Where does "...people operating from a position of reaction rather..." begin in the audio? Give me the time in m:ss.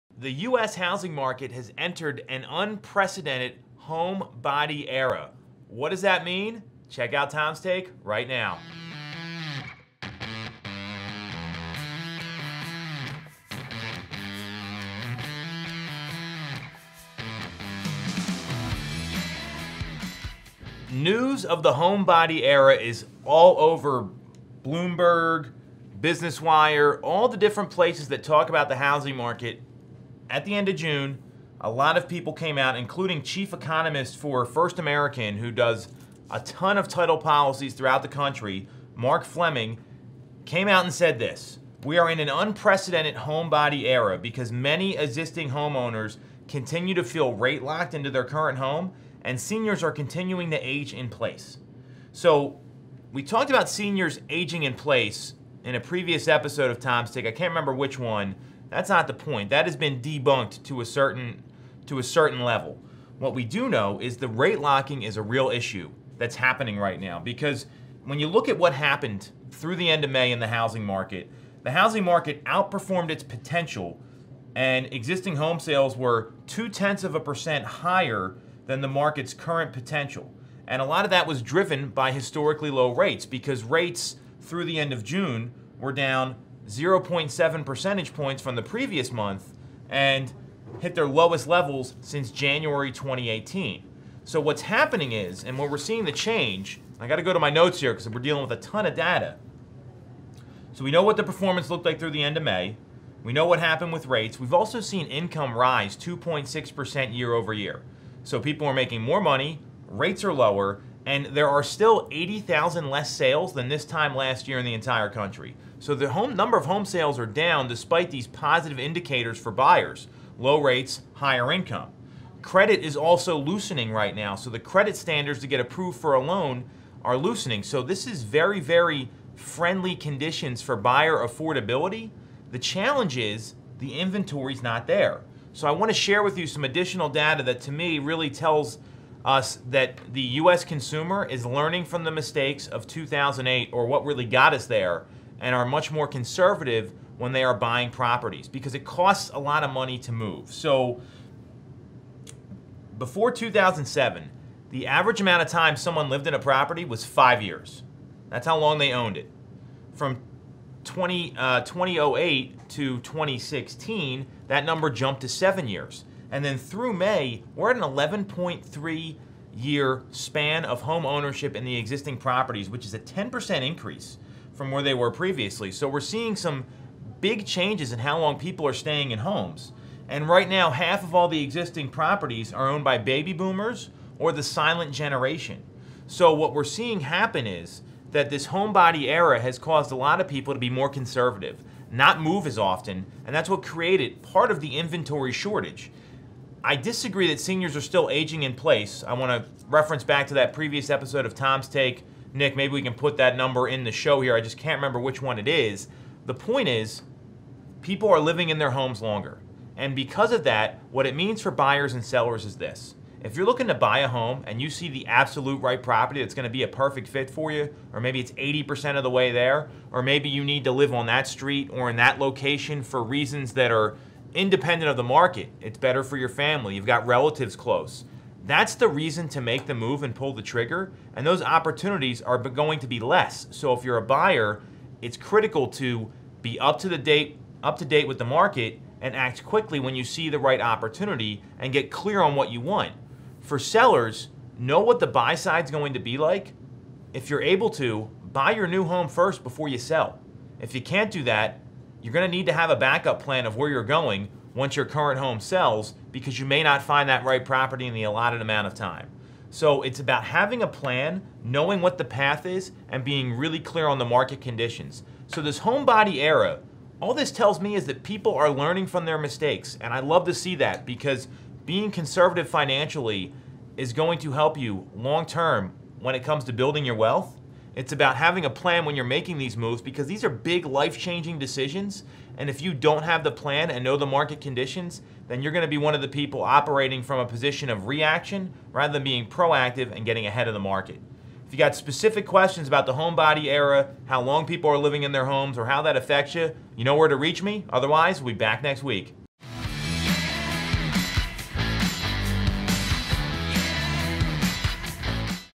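4:46.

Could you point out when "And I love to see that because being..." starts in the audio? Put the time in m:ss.
4:29.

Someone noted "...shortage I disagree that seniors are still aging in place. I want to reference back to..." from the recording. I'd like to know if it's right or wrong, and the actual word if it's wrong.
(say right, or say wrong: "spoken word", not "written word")
right.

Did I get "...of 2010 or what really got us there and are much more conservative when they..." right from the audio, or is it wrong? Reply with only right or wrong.
wrong.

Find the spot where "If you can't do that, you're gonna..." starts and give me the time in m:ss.
4:10.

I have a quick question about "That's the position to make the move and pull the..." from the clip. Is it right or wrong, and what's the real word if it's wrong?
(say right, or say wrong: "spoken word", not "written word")
wrong: "reason", not "position".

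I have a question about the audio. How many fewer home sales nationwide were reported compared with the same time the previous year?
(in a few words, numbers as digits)
80,000.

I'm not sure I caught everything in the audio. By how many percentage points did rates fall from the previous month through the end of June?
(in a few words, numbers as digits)
0.7.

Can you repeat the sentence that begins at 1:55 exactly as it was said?
So the home number of home sales are down despite these positive indicators for buyers, low rates, higher income.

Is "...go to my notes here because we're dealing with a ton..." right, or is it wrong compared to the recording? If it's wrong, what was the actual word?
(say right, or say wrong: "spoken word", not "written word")
right.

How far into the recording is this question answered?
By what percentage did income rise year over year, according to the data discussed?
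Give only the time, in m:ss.
1:45.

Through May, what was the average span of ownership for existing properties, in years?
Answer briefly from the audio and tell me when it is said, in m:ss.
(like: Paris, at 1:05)
11.3 years, at 2:47.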